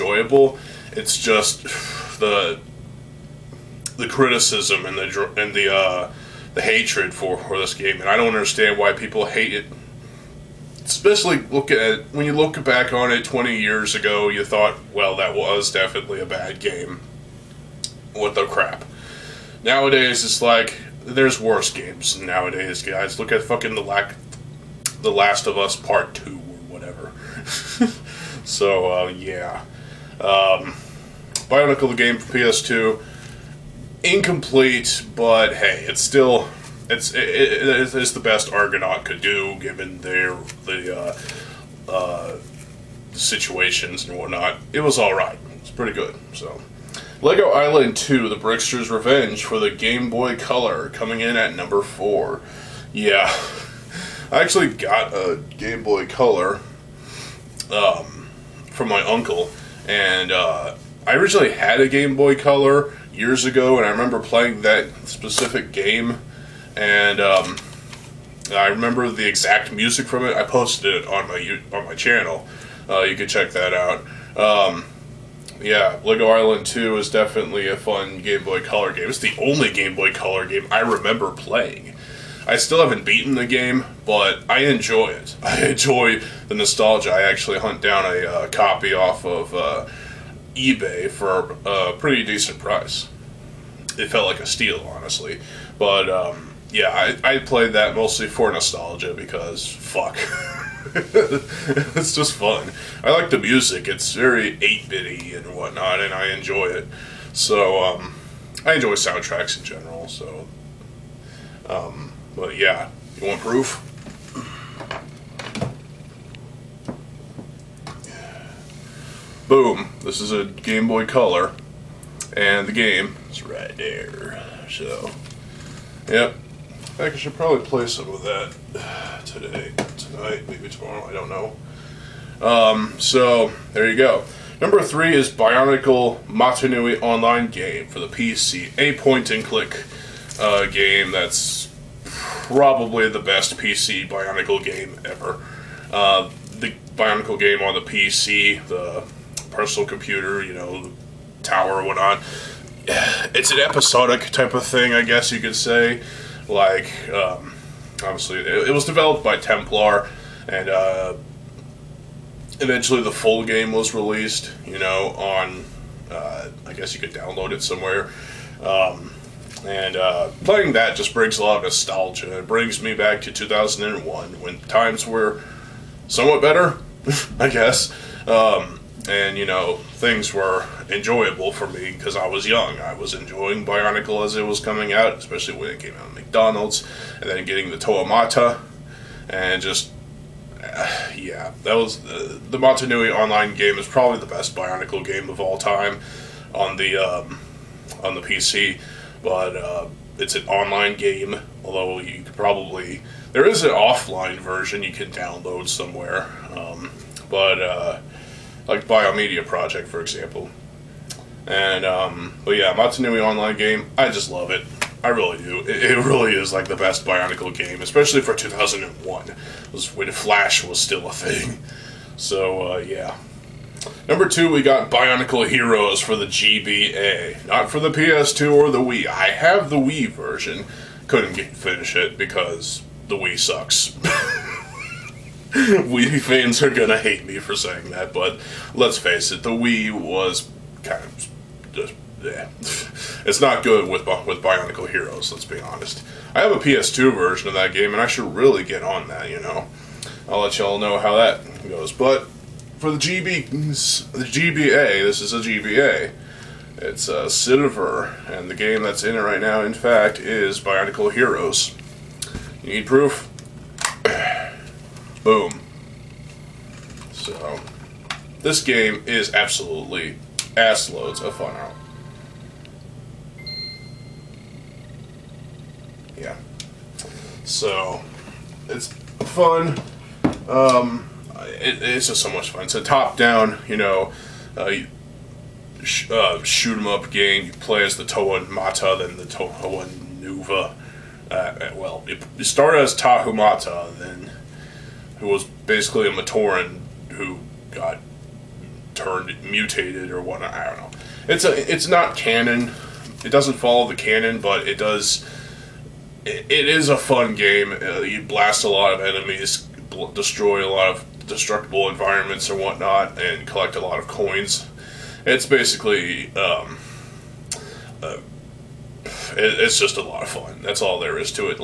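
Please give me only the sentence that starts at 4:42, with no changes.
It's a top-down, you know, uh, sh uh, shoot 'em up game.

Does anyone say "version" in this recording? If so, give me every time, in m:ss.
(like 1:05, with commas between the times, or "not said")
3:24, 3:50, 4:07.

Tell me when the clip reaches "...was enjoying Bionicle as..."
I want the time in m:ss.
3:02.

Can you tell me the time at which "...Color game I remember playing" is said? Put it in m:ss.
1:20.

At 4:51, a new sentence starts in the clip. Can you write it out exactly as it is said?
Uh, well, you start as Tahumata, then who was basically a Matoran who got turned mutated or whatnot.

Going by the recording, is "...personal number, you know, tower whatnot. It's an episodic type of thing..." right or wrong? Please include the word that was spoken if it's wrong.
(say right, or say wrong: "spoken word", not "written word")
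wrong: "computer", not "number".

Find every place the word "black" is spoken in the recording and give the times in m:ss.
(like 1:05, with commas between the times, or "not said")
not said.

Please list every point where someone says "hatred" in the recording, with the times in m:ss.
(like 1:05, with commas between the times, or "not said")
0:06.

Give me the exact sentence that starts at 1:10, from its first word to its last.
I posted it on my on my channel.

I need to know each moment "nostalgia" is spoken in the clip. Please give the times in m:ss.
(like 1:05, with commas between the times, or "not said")
1:26, 1:38, 2:51.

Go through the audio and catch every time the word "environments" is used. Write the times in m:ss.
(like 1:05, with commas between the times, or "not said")
5:11.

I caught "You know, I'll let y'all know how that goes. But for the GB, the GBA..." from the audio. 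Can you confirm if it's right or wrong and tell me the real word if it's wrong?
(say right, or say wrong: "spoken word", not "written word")
right.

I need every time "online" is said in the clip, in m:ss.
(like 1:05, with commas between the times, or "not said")
2:16, 3:13, 3:20, 3:33.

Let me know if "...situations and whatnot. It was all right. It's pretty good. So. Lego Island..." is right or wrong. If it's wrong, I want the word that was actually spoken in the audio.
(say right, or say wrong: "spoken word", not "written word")
right.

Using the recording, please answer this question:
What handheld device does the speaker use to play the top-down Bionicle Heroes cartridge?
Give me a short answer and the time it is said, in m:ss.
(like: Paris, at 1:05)
Cidiver, at 4:17.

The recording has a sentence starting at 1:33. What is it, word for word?
It felt like a steal, honestly.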